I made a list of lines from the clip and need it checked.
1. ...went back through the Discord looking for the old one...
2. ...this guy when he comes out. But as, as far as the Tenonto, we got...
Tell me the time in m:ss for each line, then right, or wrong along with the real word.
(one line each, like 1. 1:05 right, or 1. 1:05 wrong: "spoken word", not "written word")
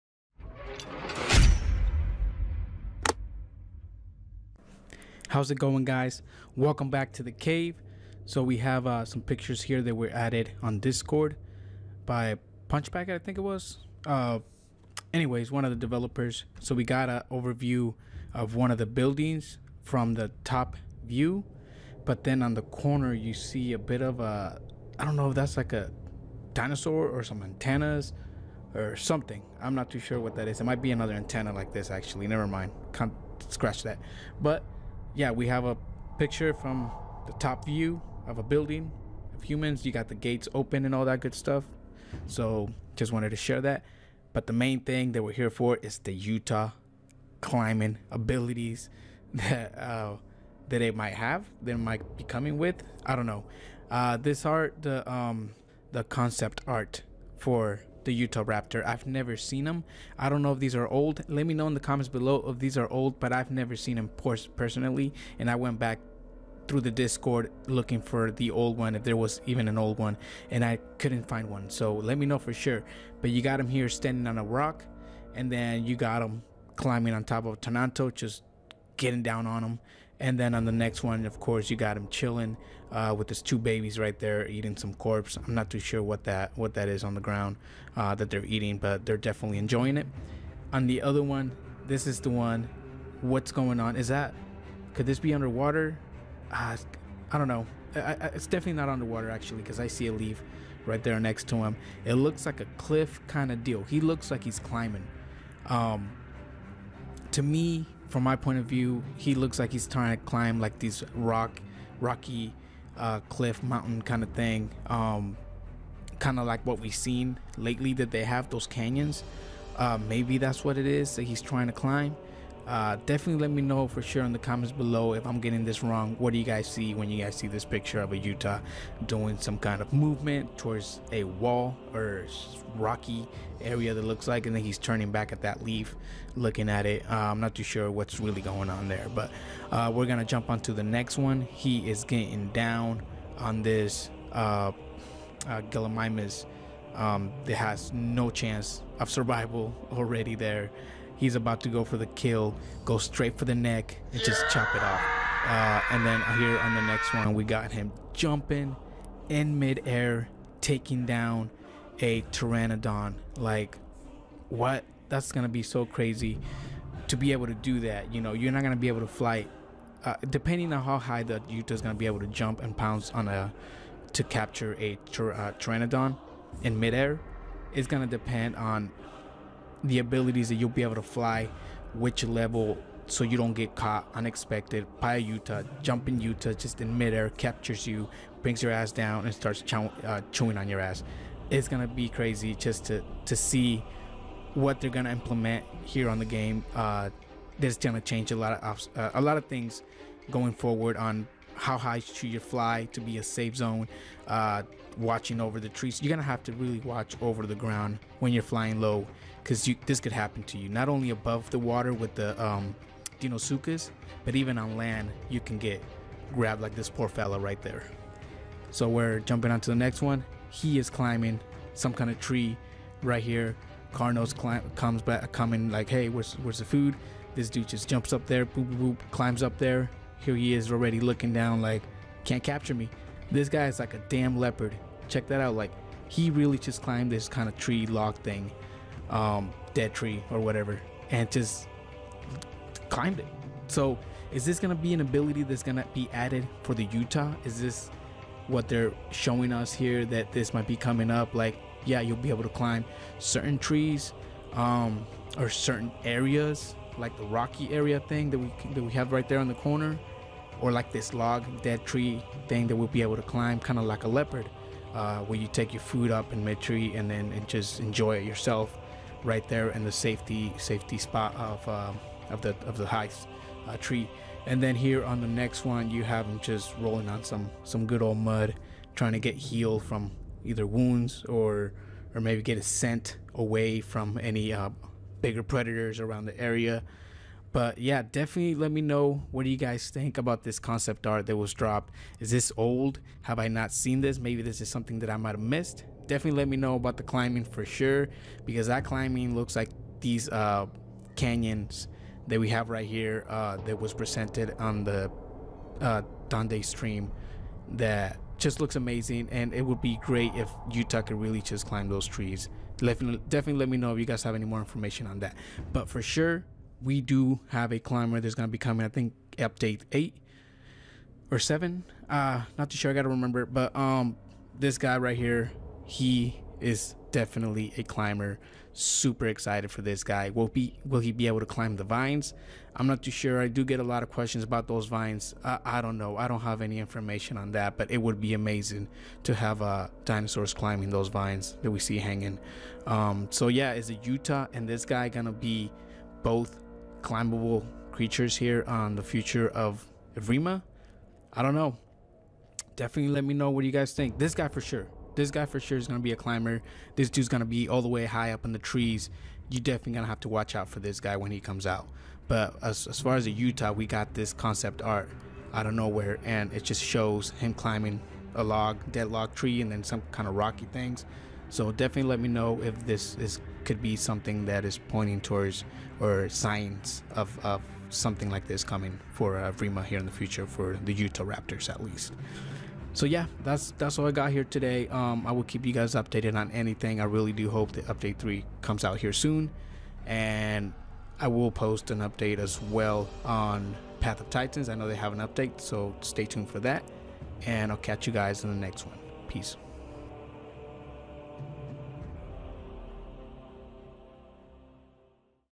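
1. 1:05 right
2. 6:00 wrong: "Utah", not "Tenonto".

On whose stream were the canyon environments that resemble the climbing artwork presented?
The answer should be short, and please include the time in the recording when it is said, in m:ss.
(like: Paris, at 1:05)
Dondi, at 5:06.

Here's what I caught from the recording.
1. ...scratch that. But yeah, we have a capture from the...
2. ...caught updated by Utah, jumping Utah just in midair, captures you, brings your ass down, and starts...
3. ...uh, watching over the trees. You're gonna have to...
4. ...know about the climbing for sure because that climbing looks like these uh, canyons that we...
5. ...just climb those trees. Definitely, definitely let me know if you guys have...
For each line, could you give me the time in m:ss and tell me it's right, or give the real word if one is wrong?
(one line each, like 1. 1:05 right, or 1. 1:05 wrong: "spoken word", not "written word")
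1. 0:33 wrong: "picture", not "capture"
2. 3:03 wrong: "unexpected", not "updated"
3. 3:24 right
4. 4:56 right
5. 5:11 right.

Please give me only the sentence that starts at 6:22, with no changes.
So yeah, that's that's all I got here today.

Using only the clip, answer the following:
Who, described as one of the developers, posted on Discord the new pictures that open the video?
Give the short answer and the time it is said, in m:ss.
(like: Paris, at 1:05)
Punchback, at 0:12.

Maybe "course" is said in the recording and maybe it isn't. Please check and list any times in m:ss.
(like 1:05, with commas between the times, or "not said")
1:21.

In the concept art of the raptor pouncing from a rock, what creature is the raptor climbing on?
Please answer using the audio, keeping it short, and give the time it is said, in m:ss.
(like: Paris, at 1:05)
Tenonto, at 1:17.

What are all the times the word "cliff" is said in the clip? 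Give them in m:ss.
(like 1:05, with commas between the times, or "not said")
1:42, 1:53.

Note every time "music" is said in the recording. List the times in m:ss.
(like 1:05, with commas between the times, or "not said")
not said.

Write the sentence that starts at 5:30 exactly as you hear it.
Will be will he be able to climb the vines?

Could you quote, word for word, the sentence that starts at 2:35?
Uh, and then here on the next one, we got him jumping in midair, taking down a pteranodon.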